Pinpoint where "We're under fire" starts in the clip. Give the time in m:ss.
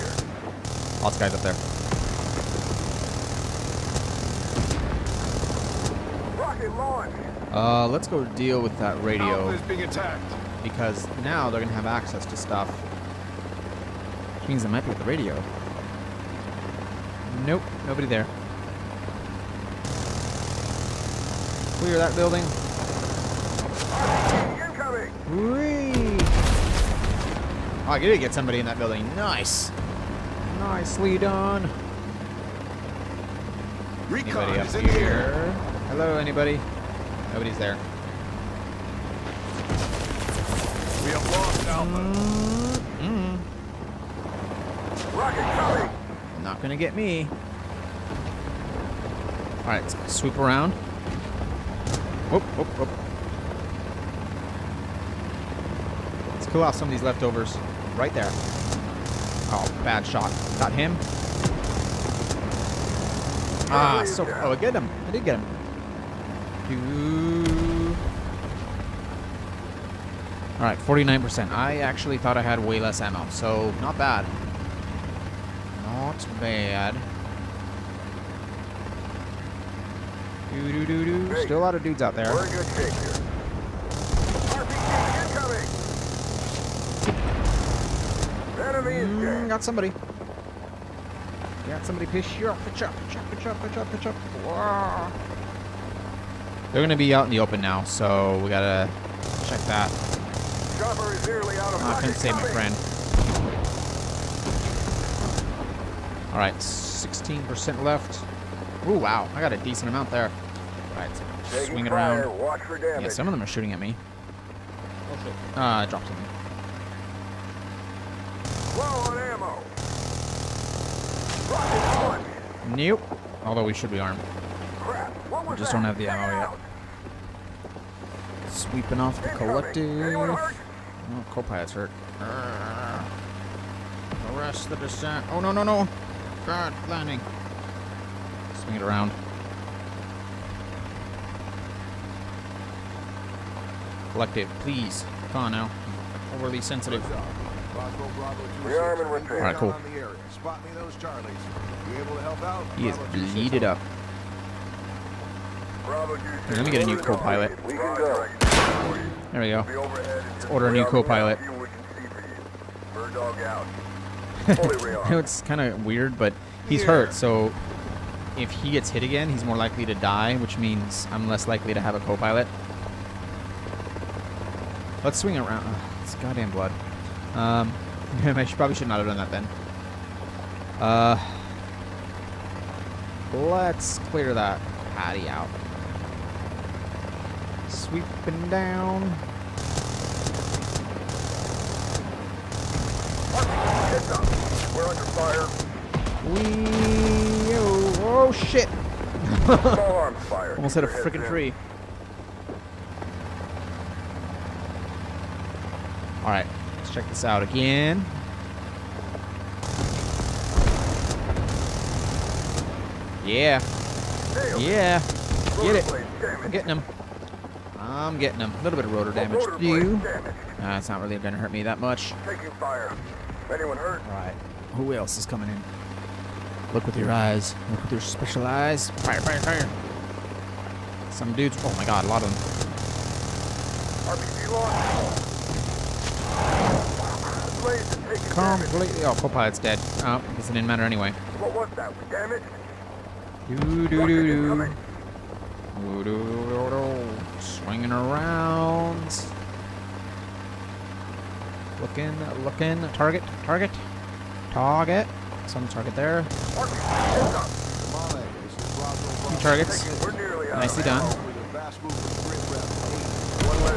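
3:14.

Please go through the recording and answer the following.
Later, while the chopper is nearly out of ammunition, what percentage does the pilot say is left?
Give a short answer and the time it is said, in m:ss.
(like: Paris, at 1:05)
16%, at 1:46.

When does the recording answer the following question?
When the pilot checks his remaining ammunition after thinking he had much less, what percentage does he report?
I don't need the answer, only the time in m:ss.
1:10.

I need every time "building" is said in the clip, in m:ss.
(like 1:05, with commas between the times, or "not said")
0:22, 0:28.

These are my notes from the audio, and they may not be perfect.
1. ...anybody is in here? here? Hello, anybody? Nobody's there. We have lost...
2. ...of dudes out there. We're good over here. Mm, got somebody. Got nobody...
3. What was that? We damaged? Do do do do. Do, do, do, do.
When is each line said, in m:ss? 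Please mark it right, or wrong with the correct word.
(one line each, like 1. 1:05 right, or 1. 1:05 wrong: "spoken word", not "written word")
1. 0:34 right
2. 1:21 wrong: "somebody", not "nobody"
3. 4:01 right.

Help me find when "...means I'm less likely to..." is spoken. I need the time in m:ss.
2:50.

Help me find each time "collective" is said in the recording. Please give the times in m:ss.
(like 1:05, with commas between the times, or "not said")
2:09, 2:24.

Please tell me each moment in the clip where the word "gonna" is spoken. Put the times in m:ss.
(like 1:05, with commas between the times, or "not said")
0:11, 0:46, 1:36.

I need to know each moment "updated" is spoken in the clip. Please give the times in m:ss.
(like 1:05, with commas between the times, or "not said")
not said.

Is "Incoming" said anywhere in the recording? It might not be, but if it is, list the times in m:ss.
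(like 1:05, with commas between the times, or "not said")
0:24.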